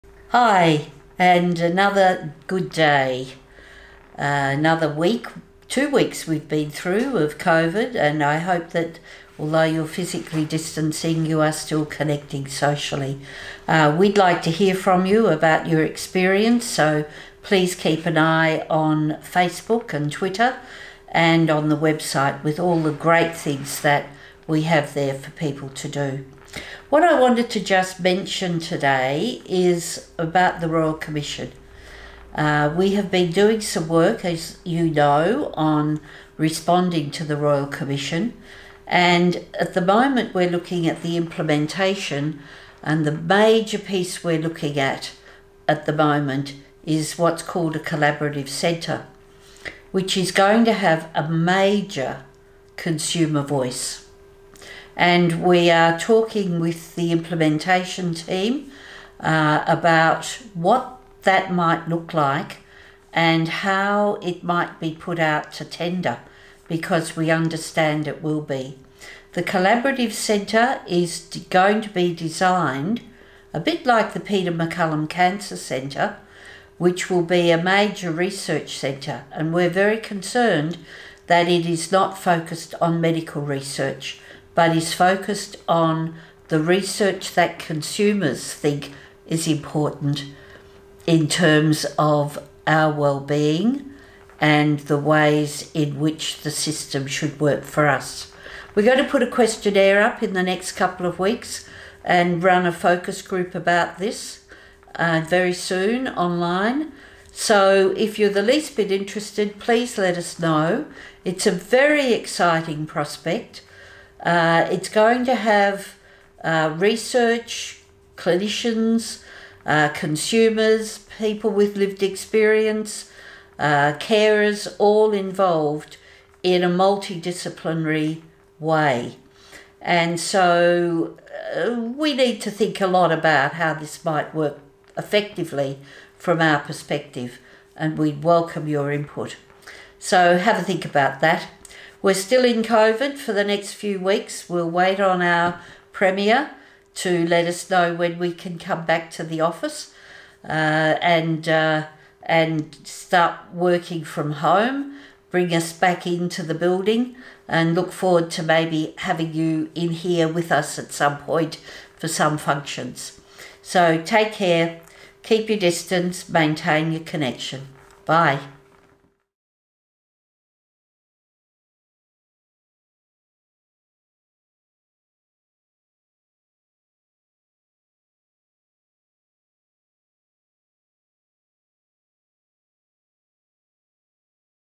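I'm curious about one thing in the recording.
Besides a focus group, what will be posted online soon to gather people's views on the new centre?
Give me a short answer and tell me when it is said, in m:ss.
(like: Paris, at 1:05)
questionnaire, at 1:39.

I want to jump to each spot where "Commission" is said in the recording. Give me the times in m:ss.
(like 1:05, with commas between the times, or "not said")
0:30, 0:37.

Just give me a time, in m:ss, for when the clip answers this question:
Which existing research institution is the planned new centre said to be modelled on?
1:14.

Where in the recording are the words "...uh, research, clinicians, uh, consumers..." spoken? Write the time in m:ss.
1:56.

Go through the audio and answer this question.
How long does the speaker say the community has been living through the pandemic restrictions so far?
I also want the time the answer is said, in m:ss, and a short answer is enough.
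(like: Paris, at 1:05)
two weeks, at 0:05.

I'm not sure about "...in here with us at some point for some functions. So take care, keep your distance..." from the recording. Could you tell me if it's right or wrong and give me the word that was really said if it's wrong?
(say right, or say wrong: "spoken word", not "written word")
right.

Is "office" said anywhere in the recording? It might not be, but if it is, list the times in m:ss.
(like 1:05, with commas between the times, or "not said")
2:29.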